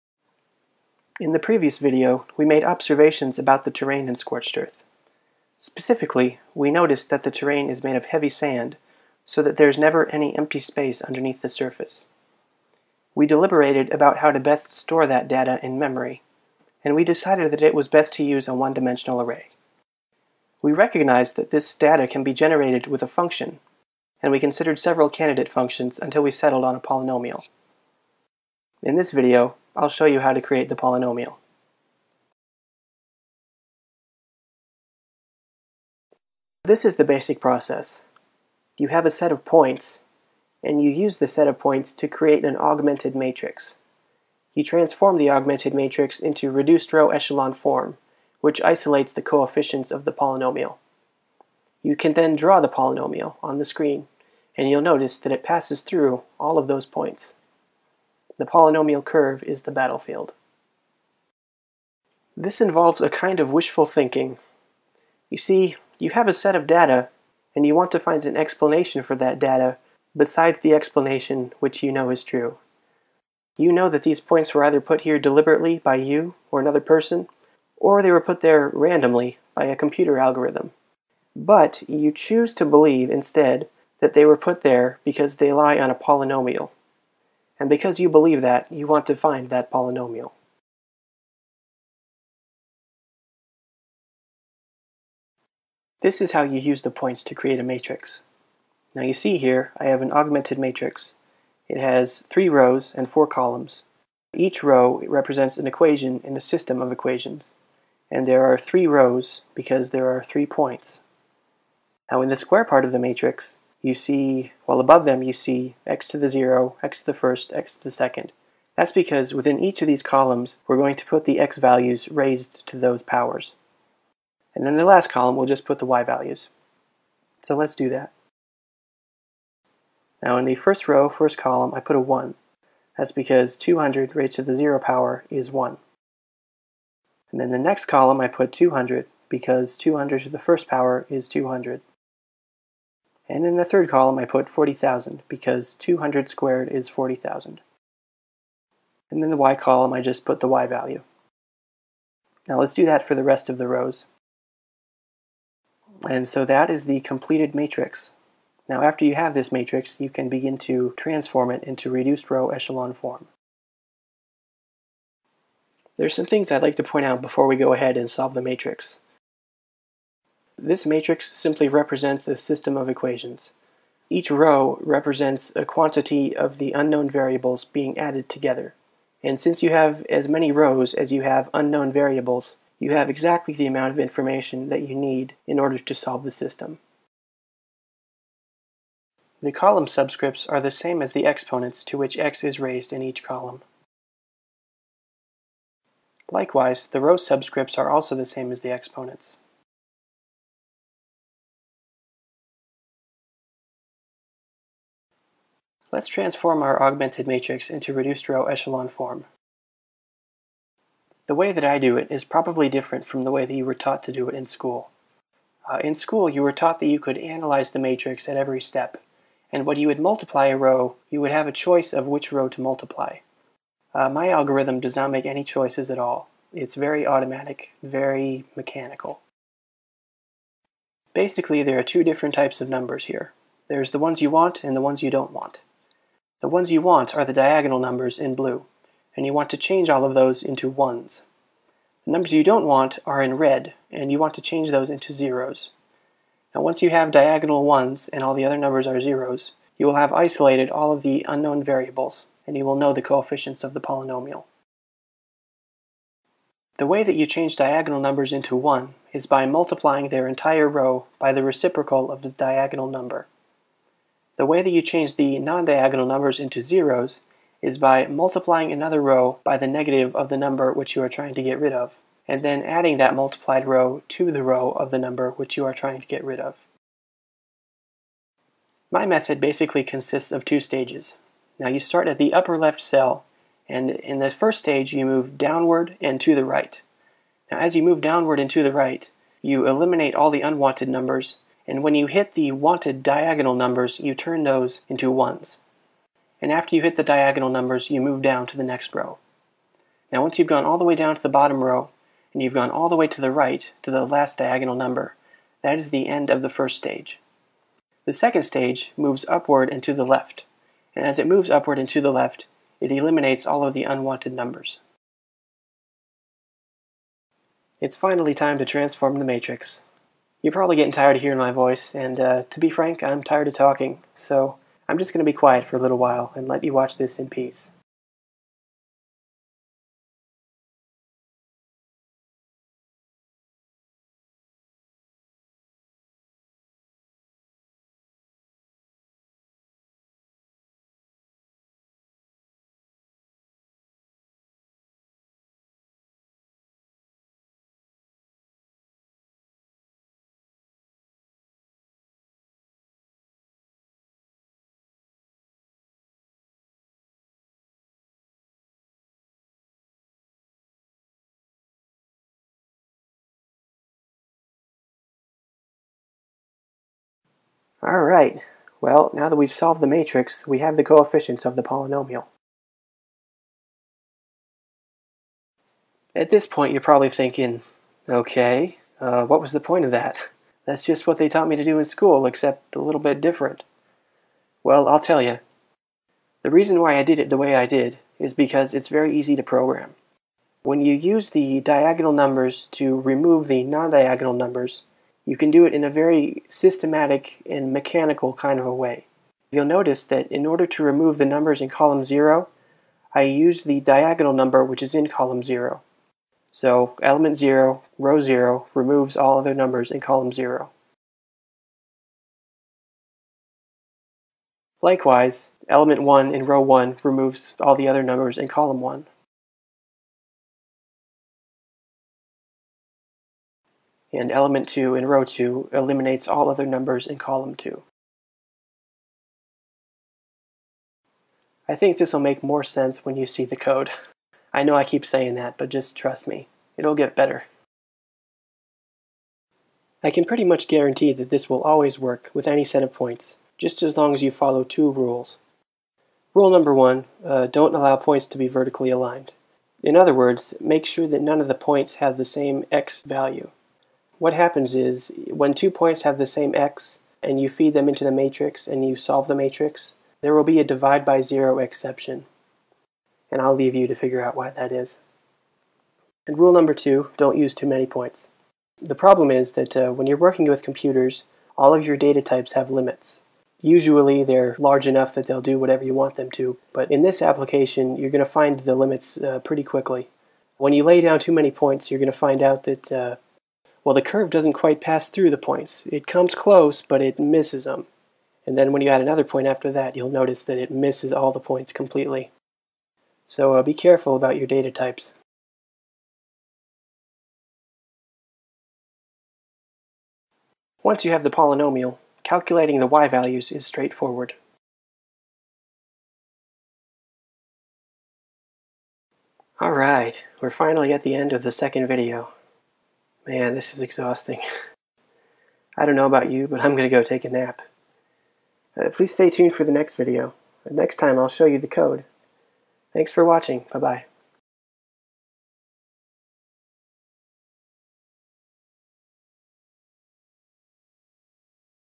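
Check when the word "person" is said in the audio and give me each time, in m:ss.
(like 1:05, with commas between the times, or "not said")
1:16.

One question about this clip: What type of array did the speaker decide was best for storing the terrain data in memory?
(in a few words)
one-dimensional.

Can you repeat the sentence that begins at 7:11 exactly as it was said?
I think this will make more sense when you see the code.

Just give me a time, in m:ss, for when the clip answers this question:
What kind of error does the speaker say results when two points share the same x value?
7:40.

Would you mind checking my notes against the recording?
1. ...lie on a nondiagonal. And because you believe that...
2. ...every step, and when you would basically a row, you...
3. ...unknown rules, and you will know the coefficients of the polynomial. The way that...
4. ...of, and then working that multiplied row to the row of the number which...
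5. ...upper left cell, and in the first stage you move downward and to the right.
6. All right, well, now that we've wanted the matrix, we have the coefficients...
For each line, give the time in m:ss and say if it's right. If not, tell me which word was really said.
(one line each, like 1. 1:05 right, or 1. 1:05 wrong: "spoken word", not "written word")
1. 1:25 wrong: "polynomial", not "nondiagonal"
2. 3:38 wrong: "multiply", not "basically"
3. 4:11 wrong: "variables", not "rules"
4. 4:31 wrong: "adding", not "working"
5. 4:42 right
6. 6:07 wrong: "solved", not "wanted".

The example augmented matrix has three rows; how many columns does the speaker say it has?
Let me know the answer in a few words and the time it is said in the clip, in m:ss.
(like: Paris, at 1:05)
4, at 1:43.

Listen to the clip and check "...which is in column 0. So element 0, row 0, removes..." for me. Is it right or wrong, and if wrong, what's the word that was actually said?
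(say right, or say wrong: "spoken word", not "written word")
right.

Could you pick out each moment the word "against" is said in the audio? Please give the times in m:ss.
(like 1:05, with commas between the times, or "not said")
not said.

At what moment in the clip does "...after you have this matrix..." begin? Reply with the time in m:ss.
2:38.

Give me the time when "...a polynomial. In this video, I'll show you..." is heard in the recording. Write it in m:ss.
0:26.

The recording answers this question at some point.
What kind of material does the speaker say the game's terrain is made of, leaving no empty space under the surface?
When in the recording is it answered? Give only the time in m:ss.
0:08.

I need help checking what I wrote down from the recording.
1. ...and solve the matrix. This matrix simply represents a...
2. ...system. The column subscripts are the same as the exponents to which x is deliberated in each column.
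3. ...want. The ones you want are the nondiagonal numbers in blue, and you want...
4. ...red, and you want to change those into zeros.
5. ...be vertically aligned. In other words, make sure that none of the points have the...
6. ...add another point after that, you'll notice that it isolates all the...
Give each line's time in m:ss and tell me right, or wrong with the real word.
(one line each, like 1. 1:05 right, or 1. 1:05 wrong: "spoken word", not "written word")
1. 2:47 right
2. 3:06 wrong: "raised", not "deliberated"
3. 3:55 wrong: "diagonal", not "nondiagonal"
4. 4:03 right
5. 7:28 right
6. 8:08 wrong: "misses", not "isolates".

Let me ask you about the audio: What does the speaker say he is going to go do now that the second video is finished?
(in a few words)
take a nap.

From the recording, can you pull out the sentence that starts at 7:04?
and element 2 in row 2 eliminates all other numbers in column 2.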